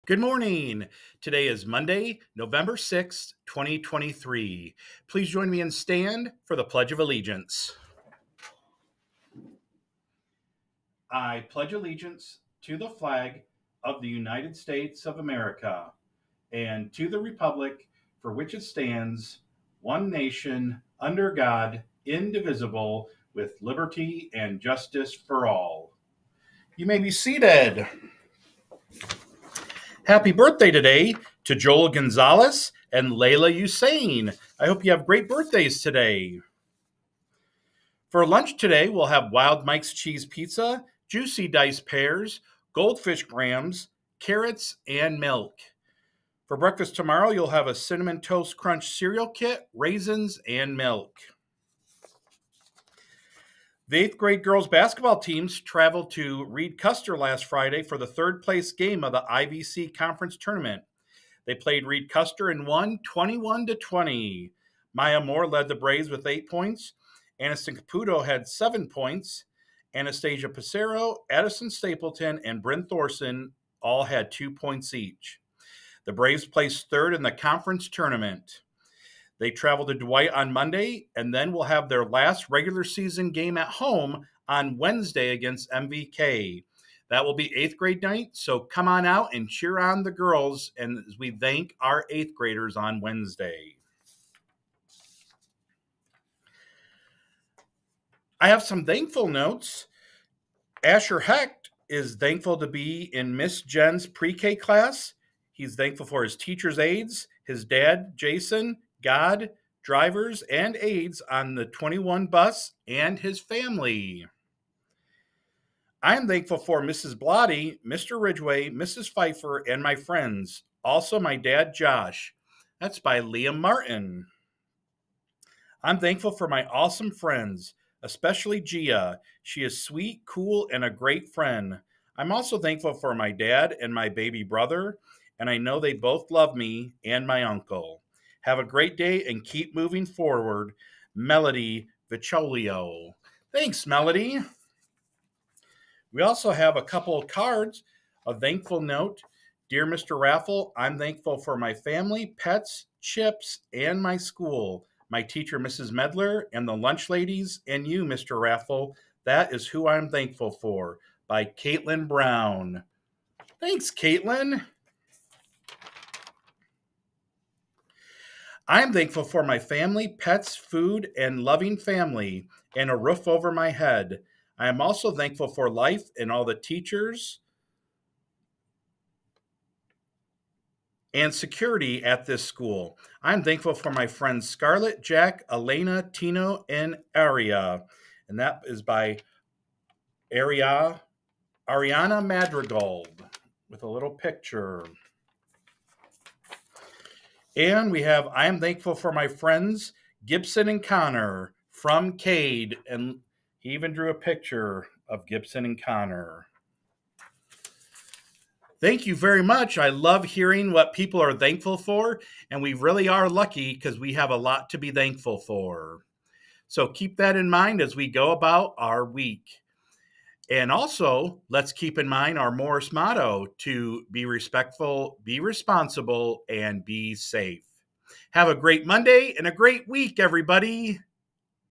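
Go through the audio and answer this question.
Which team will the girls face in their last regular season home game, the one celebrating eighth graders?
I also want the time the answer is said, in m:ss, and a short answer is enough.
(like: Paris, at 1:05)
MVK, at 1:25.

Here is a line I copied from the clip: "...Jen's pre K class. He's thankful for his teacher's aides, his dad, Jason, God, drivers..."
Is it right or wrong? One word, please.
right.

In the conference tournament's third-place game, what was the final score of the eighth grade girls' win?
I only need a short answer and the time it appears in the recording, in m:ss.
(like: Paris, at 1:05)
21 to 20, at 1:03.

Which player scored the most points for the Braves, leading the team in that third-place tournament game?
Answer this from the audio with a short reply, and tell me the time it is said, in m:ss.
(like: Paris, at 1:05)
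Maya Moore, at 1:04.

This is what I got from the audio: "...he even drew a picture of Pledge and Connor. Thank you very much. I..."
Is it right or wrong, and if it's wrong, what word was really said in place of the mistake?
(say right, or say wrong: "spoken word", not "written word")
wrong: "Gibson", not "Pledge".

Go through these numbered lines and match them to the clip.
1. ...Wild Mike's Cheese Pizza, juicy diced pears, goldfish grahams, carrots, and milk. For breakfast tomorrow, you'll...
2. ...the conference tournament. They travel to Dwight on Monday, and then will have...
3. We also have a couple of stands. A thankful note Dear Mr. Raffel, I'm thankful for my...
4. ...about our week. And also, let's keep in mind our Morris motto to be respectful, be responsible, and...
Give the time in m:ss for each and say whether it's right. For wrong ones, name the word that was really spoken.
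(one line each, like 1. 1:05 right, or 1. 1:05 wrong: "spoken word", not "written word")
1. 0:39 right
2. 1:17 right
3. 2:26 wrong: "cards", not "stands"
4. 3:38 right.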